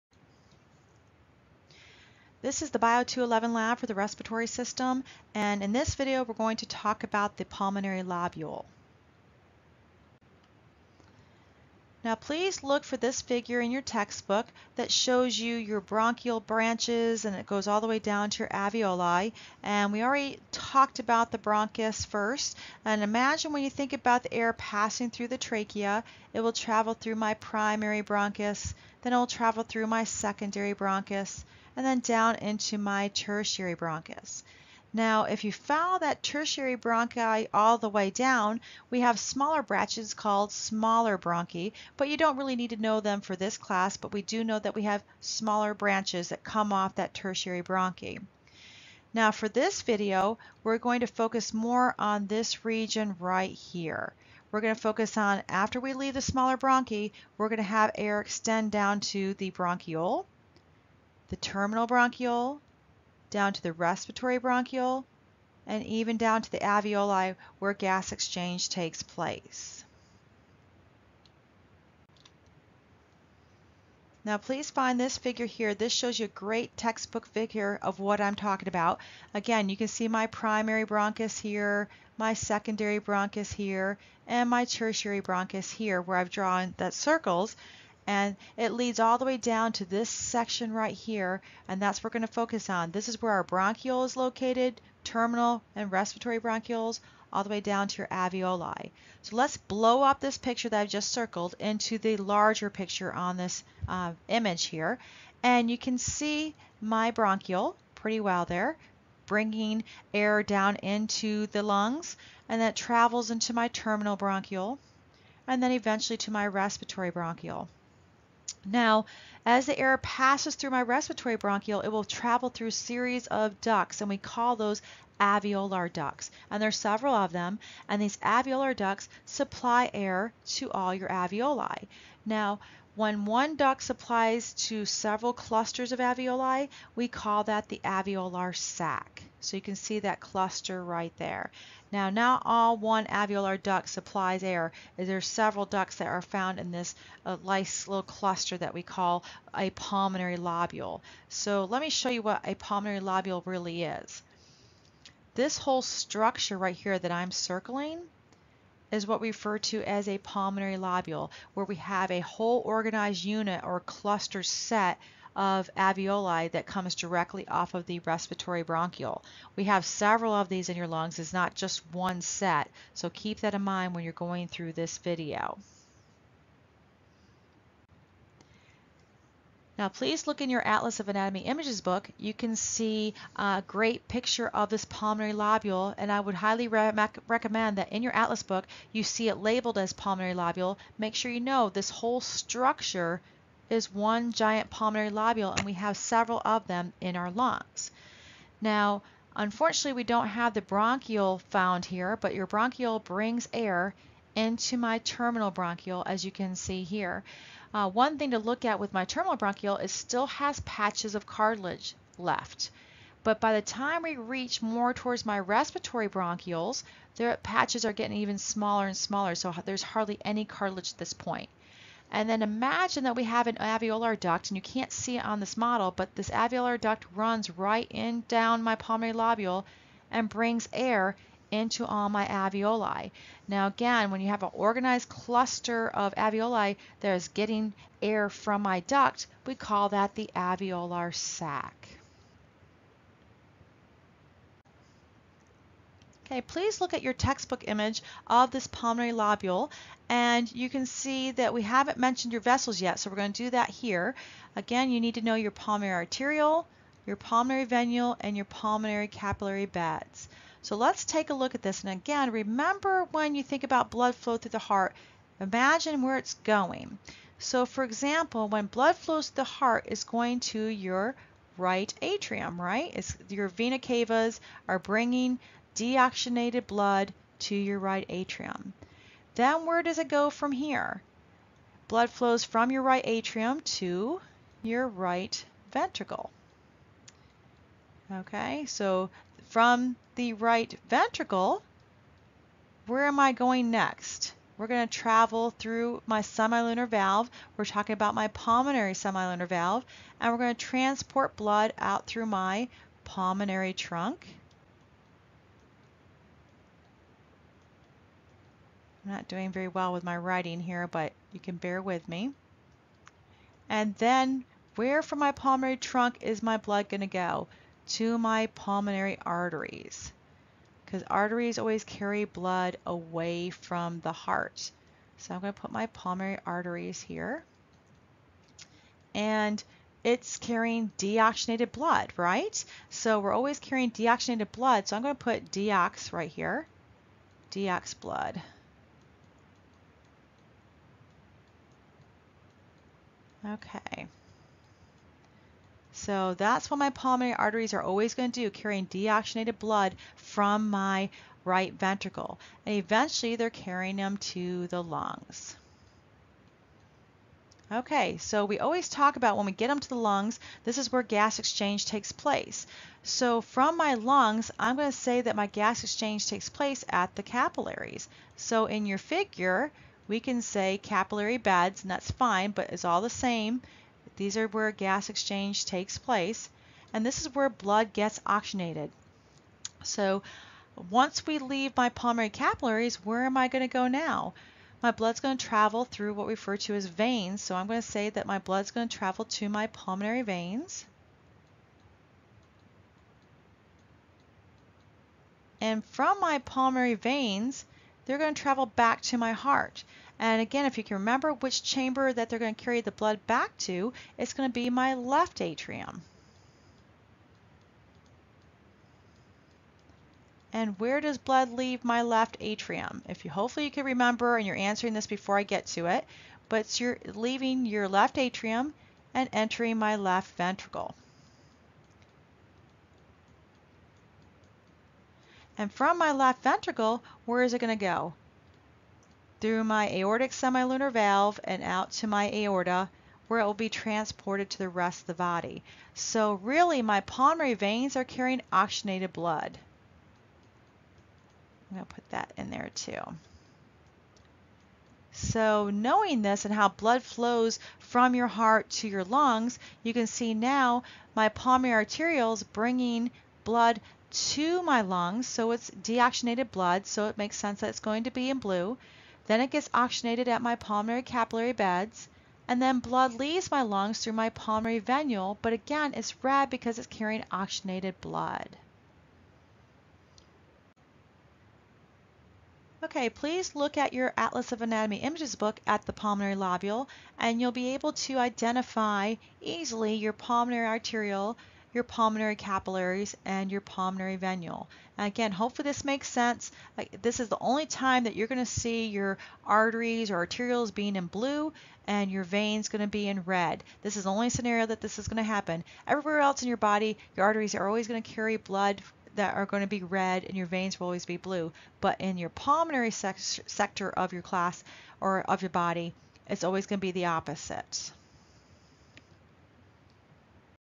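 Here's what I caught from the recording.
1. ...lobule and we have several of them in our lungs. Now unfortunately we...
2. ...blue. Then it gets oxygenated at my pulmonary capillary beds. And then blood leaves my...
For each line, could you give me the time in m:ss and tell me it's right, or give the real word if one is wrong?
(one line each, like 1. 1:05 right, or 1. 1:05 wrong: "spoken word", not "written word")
1. 3:15 right
2. 7:38 right.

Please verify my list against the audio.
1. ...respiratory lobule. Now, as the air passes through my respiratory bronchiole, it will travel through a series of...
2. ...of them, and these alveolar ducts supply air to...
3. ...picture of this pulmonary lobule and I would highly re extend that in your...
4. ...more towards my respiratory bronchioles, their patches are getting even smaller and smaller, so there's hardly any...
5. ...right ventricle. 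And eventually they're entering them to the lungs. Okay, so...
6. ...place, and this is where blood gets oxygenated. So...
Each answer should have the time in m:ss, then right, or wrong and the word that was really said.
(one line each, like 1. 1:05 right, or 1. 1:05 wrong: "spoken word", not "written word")
1. 1:56 wrong: "bronchiole", not "lobule"
2. 2:07 right
3. 3:04 wrong: "recommend", not "extend"
4. 3:34 right
5. 5:51 wrong: "carrying", not "entering"
6. 6:15 right.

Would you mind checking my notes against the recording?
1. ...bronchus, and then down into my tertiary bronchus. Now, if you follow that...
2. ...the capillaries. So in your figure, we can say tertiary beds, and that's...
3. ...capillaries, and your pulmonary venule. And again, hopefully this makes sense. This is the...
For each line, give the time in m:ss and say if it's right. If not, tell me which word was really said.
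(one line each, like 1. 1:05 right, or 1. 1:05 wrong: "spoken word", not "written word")
1. 0:30 right
2. 6:07 wrong: "capillary", not "tertiary"
3. 8:02 right.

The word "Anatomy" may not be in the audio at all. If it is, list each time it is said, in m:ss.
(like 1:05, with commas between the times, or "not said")
3:01, 7:54.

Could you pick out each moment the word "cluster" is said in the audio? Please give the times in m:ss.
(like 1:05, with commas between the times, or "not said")
2:15, 2:20, 2:28, 2:43, 3:55.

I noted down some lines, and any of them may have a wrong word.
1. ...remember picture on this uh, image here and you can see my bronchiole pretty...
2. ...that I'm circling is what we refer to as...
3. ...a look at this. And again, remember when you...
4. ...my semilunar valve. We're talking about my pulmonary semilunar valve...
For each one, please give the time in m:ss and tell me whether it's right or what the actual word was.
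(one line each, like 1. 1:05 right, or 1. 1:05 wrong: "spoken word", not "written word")
1. 1:42 wrong: "larger", not "remember"
2. 2:36 right
3. 4:21 right
4. 4:56 right.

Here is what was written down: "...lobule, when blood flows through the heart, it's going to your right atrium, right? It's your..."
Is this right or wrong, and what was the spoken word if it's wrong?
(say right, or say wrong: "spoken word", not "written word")
wrong: "example", not "lobule".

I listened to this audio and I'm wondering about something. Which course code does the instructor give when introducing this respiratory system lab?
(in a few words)
Bio211.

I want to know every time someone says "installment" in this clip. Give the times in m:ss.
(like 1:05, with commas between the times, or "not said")
not said.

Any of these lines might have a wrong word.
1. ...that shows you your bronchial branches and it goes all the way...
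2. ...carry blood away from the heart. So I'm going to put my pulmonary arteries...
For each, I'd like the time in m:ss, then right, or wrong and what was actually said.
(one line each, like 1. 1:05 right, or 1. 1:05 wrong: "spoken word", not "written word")
1. 0:14 right
2. 5:21 right.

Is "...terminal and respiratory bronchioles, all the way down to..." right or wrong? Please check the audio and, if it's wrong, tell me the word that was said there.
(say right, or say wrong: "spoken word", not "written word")
right.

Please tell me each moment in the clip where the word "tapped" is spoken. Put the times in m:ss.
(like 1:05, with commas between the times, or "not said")
not said.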